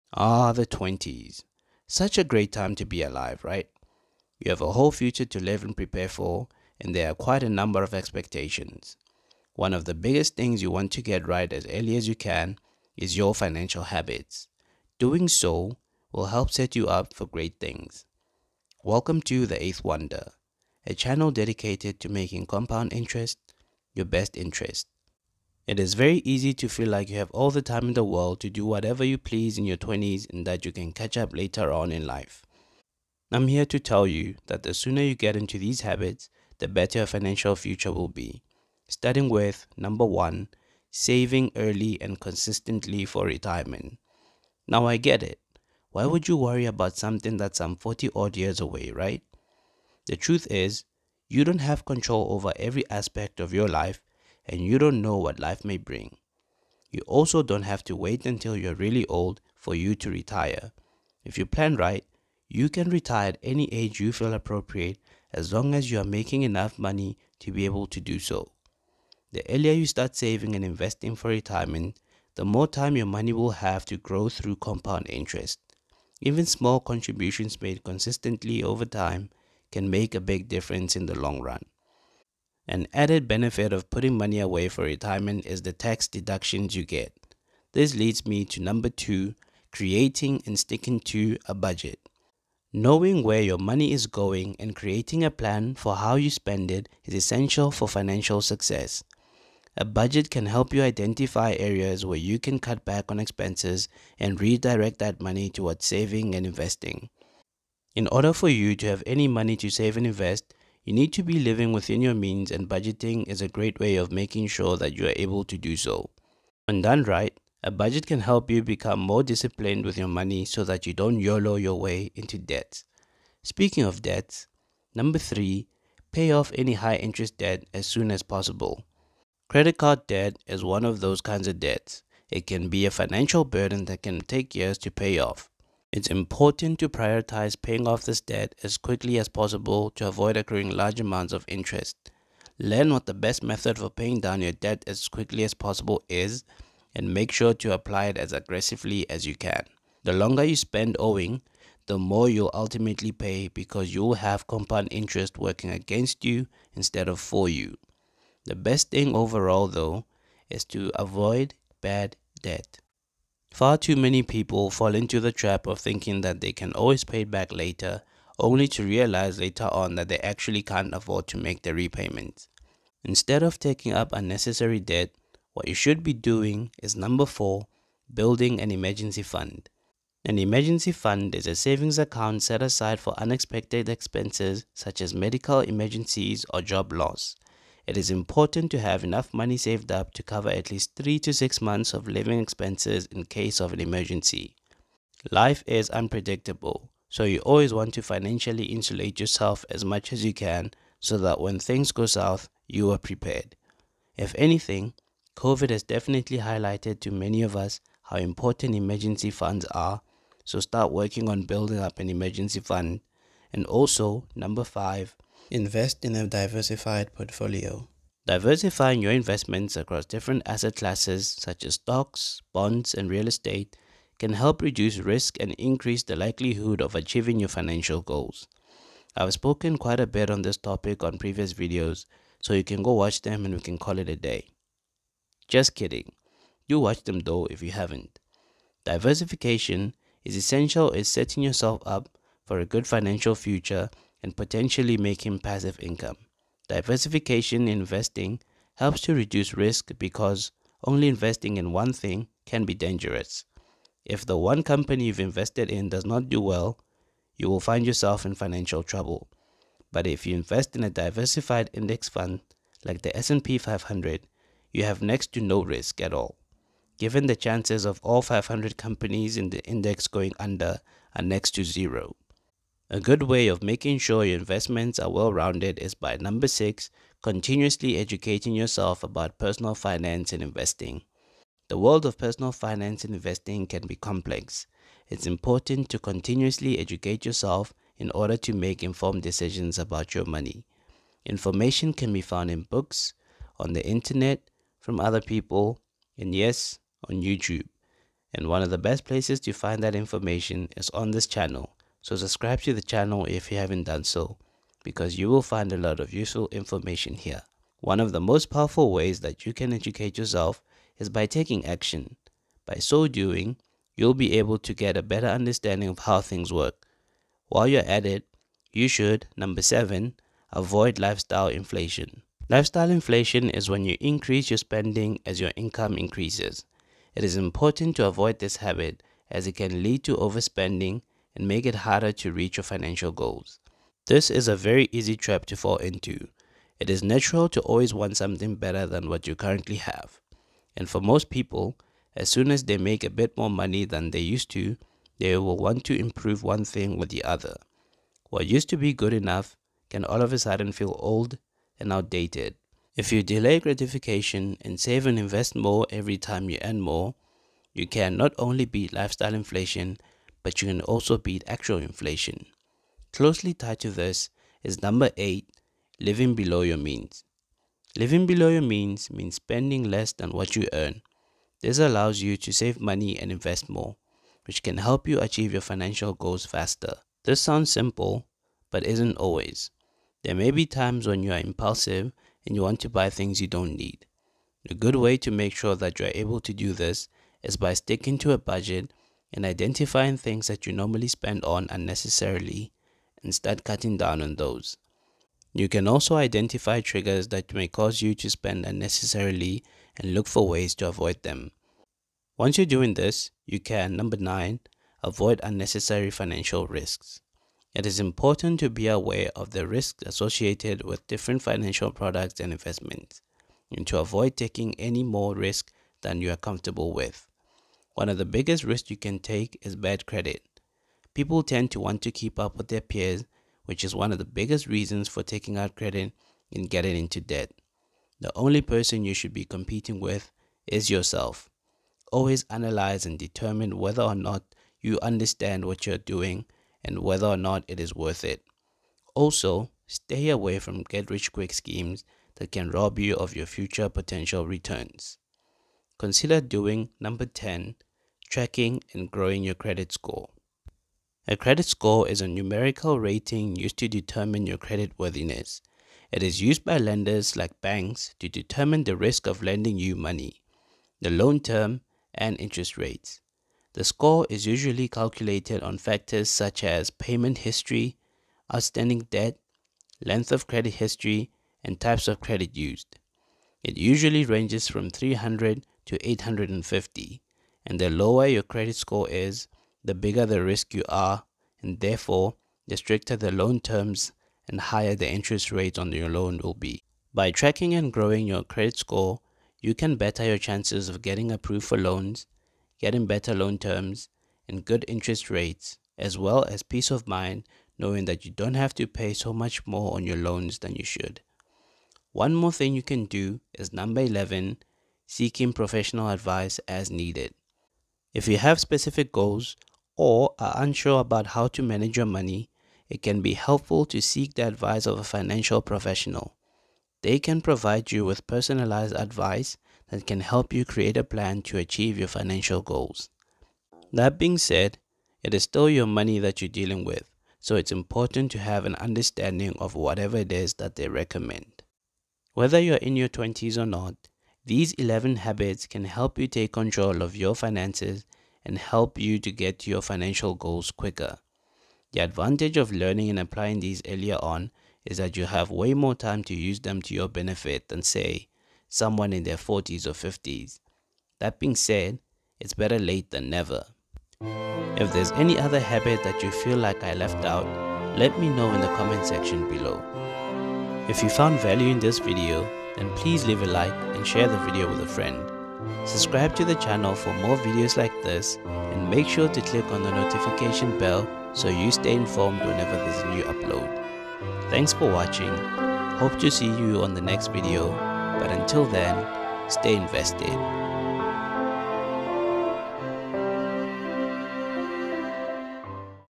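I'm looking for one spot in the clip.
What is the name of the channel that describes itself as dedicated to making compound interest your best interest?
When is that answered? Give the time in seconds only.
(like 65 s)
19 s.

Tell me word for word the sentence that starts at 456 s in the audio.
It is used by lenders like banks to determine the risk of lending you money, the loan term, and interest rates.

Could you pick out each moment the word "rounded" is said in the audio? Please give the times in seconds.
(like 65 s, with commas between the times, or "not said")
275 s.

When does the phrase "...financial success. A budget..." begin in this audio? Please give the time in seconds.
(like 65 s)
97 s.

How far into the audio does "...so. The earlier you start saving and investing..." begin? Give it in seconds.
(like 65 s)
68 s.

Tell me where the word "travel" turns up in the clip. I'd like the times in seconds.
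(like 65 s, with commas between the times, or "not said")
not said.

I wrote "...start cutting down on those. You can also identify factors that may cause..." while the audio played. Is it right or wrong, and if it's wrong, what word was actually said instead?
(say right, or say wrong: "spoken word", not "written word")
wrong: "triggers", not "factors".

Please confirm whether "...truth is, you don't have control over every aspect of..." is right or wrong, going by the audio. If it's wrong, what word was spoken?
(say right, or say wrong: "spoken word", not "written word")
right.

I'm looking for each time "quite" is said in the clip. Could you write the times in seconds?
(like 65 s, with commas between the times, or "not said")
7 s, 229 s.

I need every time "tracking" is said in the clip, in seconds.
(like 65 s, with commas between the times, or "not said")
448 s, 487 s.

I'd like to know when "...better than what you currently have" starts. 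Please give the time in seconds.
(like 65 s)
338 s.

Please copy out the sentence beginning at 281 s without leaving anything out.
The world of personal finance and investing can be complex.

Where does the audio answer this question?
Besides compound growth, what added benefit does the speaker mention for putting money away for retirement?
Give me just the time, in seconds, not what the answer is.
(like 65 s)
85 s.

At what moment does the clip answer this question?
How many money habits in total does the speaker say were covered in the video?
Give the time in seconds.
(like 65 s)
534 s.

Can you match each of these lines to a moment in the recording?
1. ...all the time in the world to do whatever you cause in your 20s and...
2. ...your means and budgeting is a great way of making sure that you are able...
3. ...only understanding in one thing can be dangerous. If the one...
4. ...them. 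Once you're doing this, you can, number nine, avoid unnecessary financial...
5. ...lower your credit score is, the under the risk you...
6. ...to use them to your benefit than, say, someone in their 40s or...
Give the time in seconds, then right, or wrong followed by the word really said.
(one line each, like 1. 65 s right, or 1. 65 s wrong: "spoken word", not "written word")
1. 27 s wrong: "please", not "cause"
2. 112 s right
3. 250 s wrong: "investing", not "understanding"
4. 401 s right
5. 477 s wrong: "bigger", not "under"
6. 546 s right.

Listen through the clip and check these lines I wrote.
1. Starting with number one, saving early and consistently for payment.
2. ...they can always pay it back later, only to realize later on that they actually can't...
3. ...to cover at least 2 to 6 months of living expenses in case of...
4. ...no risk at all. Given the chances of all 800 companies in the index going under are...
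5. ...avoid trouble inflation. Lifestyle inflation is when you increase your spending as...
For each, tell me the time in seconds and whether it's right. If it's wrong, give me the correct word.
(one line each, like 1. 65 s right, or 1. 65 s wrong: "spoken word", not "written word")
1. 38 s wrong: "retirement", not "payment"
2. 166 s right
3. 190 s wrong: "3", not "2"
4. 265 s wrong: "500", not "800"
5. 320 s wrong: "lifestyle", not "trouble".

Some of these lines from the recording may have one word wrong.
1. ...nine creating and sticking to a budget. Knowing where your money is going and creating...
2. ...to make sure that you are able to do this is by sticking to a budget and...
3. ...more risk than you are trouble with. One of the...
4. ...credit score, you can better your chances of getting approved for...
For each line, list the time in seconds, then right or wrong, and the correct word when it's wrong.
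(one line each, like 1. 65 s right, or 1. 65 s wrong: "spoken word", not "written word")
1. 88 s wrong: "two", not "nine"
2. 385 s right
3. 415 s wrong: "comfortable", not "trouble"
4. 488 s right.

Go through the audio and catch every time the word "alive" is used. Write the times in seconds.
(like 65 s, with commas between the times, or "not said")
3 s.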